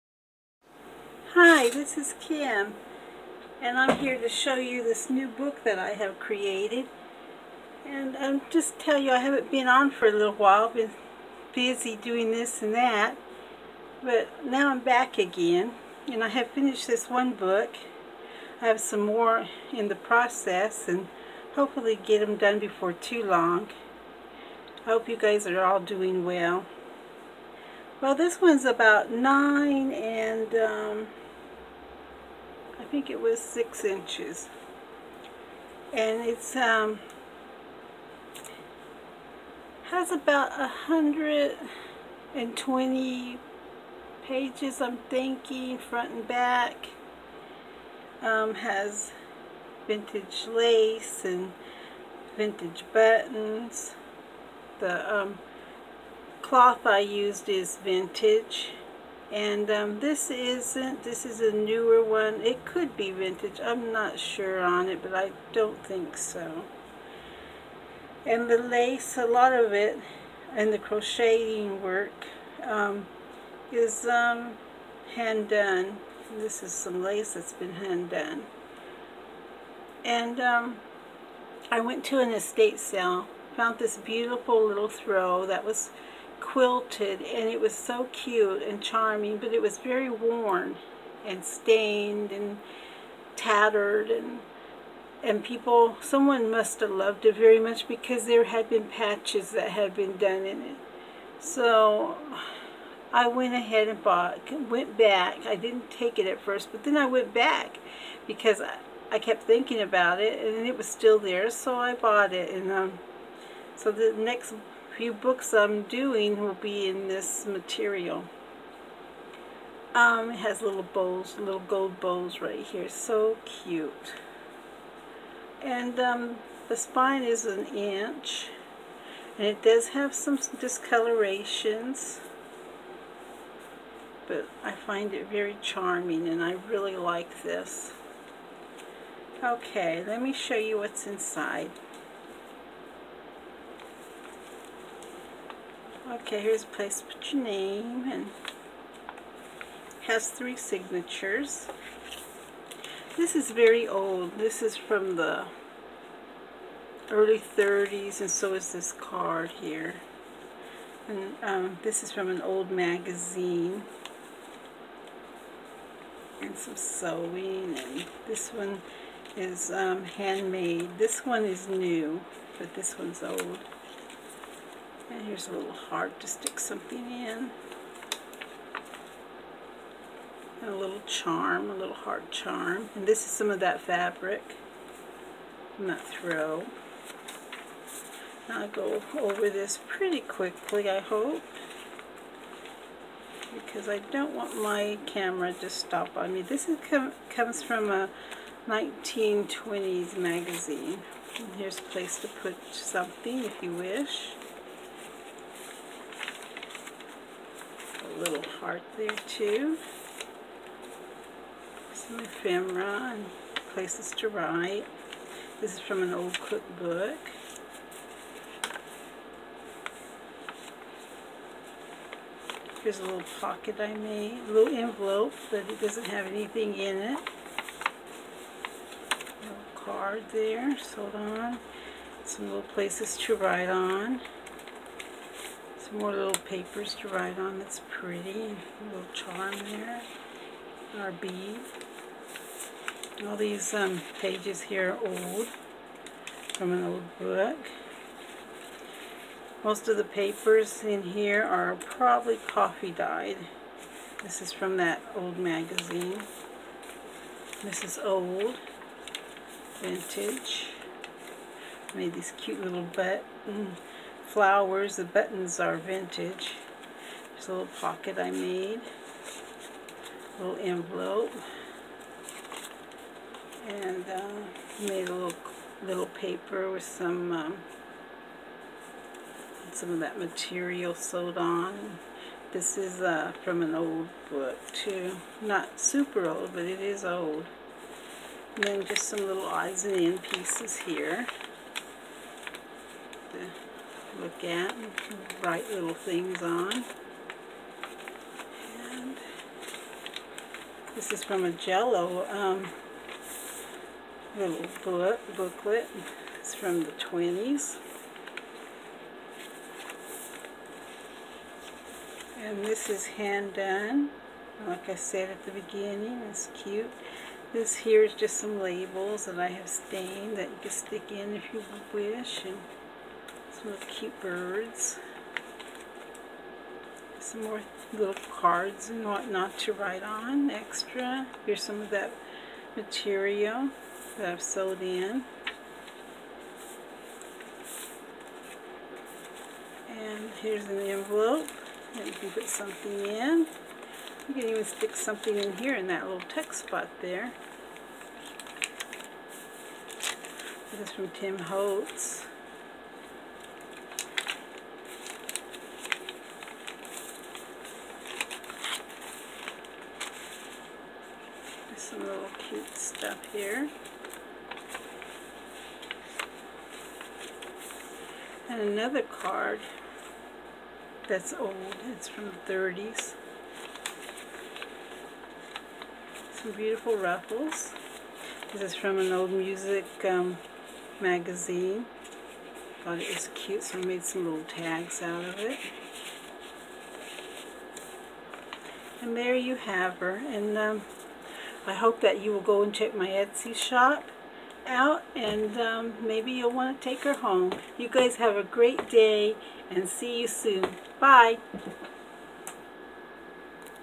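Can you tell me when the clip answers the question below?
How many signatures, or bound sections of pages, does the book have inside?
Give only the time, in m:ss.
2:30.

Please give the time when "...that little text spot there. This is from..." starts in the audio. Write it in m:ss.
5:45.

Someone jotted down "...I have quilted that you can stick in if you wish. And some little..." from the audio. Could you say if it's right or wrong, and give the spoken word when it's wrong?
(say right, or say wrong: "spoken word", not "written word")
wrong: "stained", not "quilted".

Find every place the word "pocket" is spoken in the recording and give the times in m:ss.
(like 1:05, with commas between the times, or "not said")
3:43, 4:27.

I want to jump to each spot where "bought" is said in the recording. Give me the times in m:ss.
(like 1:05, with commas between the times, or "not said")
1:44, 1:51.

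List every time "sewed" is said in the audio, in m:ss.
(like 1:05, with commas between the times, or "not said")
4:40, 5:34.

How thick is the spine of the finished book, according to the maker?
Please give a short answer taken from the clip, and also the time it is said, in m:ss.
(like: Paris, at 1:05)
1 inch, at 2:07.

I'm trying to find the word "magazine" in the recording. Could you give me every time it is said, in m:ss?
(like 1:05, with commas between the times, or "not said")
2:42, 3:20, 4:15, 6:20.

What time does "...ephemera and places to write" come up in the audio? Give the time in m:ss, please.
3:32.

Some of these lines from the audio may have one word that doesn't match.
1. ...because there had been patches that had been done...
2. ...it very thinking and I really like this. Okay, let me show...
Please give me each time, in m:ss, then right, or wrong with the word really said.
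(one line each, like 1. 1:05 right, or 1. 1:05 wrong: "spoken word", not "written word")
1. 1:37 right
2. 2:15 wrong: "charming", not "thinking".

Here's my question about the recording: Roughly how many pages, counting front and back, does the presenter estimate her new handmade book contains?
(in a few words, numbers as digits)
120.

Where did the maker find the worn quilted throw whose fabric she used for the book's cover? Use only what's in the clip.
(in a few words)
estate sale.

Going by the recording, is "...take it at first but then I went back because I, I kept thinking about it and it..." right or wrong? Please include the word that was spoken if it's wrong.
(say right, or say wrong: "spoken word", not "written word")
right.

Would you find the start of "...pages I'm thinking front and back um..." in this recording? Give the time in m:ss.
0:44.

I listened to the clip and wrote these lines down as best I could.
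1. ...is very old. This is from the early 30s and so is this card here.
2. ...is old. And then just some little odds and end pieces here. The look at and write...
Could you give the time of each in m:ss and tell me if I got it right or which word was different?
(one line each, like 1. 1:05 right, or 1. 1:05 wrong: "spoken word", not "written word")
1. 2:33 right
2. 4:46 right.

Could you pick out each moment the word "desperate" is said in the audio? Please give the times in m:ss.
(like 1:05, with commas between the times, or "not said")
not said.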